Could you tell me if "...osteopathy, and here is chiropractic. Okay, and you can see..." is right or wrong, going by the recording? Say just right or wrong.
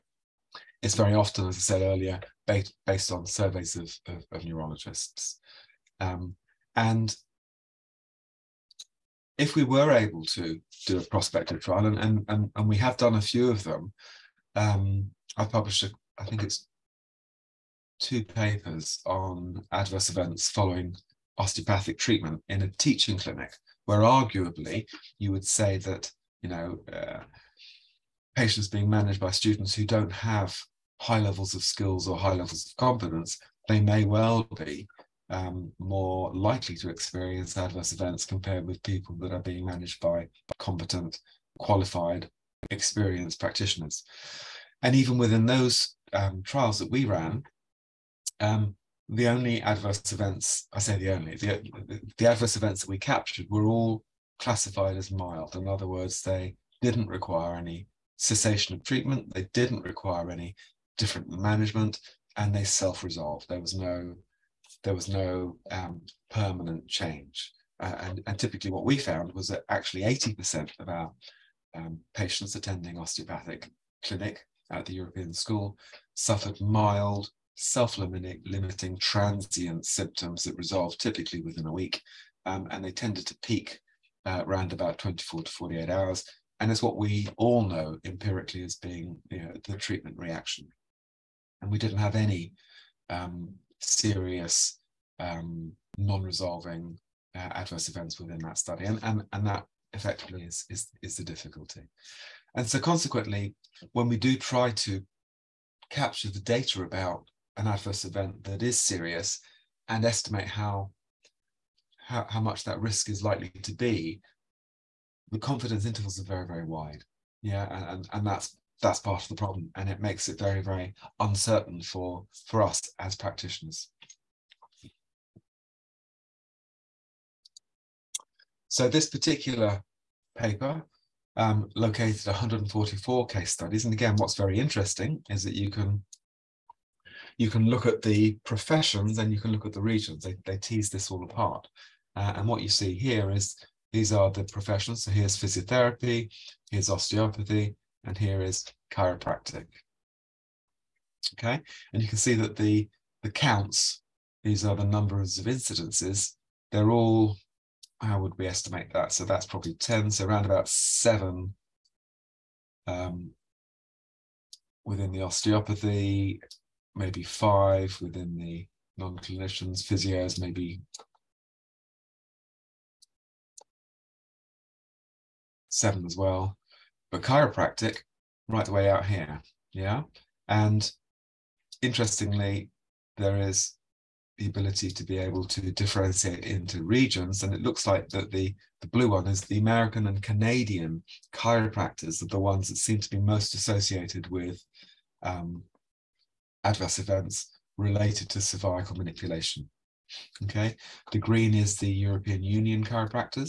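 right.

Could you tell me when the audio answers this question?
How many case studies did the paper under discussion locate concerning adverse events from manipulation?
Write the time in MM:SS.
02:12.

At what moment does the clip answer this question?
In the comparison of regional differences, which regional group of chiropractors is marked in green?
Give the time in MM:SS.
03:21.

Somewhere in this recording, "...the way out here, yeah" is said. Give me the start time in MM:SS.
02:58.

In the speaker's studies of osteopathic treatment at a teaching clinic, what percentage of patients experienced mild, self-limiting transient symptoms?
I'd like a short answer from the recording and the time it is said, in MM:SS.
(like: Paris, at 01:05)
80%, at 01:10.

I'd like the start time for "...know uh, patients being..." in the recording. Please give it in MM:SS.
00:26.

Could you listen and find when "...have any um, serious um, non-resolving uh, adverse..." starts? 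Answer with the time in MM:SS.
01:31.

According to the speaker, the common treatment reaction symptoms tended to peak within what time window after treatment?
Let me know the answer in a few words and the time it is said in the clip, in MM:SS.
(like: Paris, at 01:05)
24 to 48 hours, at 01:24.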